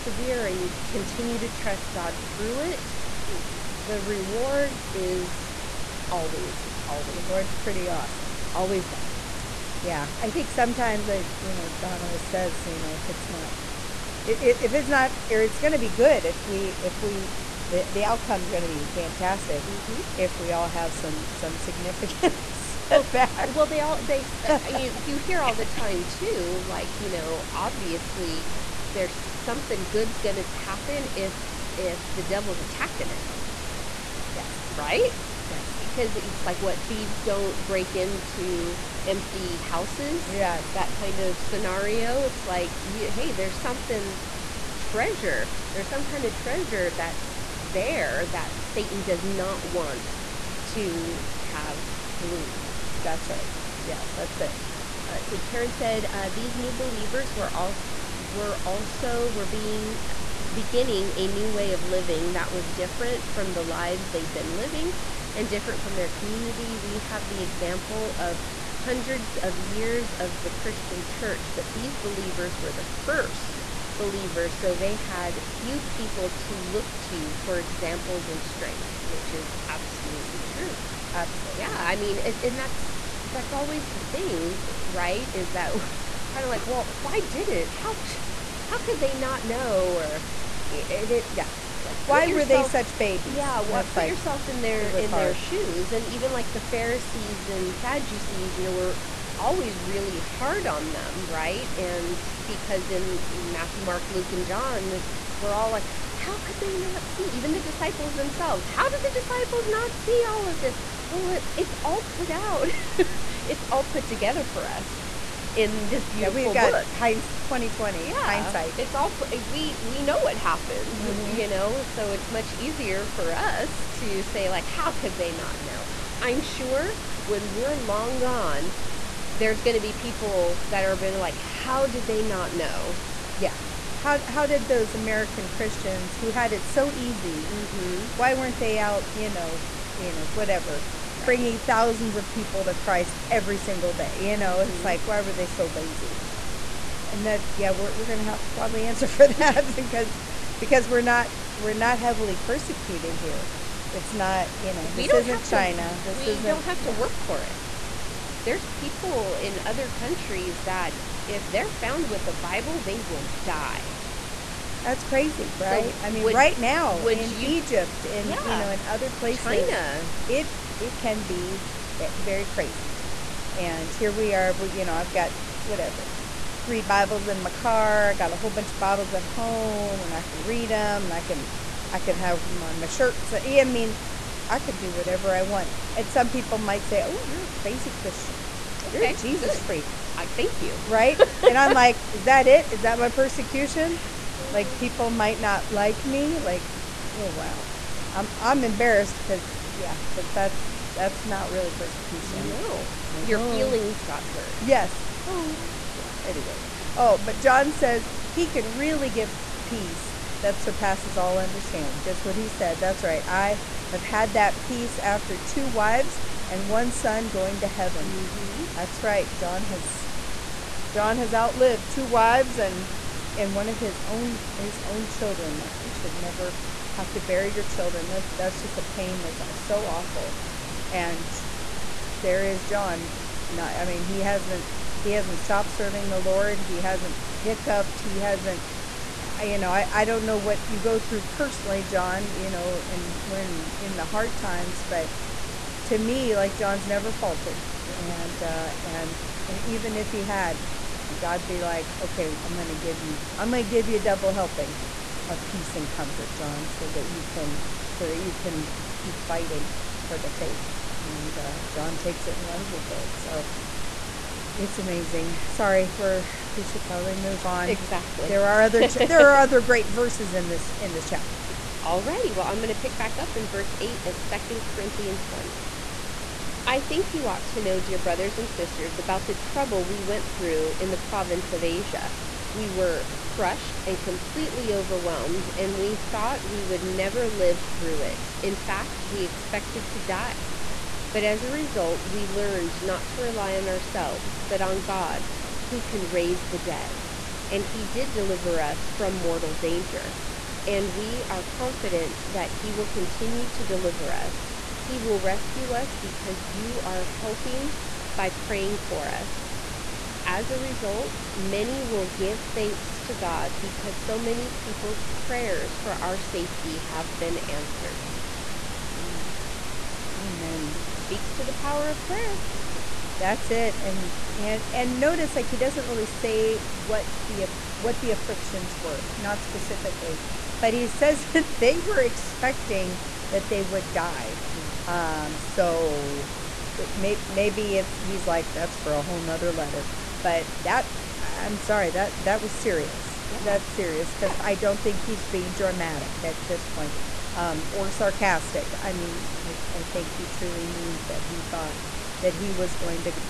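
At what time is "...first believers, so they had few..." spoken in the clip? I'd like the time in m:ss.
1:13.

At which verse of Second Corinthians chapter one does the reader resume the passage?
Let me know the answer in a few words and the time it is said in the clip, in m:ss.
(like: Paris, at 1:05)
Verse 8, at 4:33.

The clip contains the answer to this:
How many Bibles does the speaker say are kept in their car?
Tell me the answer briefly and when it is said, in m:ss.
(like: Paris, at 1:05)
3, at 2:56.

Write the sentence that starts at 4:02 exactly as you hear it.
You know, and when in the hard times, but to me, like John's never faltered, mm-hmm.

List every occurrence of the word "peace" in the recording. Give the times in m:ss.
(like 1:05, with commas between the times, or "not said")
3:29, 3:34, 4:15.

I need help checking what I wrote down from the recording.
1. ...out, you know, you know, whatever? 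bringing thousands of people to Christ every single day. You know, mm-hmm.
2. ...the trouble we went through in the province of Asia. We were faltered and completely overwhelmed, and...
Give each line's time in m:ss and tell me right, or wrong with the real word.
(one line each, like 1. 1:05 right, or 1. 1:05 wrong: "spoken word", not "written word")
1. 2:18 right
2. 4:39 wrong: "crushed", not "faltered".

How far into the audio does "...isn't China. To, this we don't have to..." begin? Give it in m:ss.
2:35.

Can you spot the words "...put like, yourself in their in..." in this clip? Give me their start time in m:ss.
1:33.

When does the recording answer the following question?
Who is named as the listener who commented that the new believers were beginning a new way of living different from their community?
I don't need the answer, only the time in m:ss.
0:55.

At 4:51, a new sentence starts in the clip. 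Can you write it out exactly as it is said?
But as a result, we learned not to rely on ourselves, but on God, who can raise the dead.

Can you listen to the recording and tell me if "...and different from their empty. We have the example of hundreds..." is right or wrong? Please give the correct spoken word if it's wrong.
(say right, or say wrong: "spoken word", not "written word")
wrong: "community", not "empty".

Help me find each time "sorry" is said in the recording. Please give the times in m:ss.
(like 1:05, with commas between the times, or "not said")
4:25, 5:41.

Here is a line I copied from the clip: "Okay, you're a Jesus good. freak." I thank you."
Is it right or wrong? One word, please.
right.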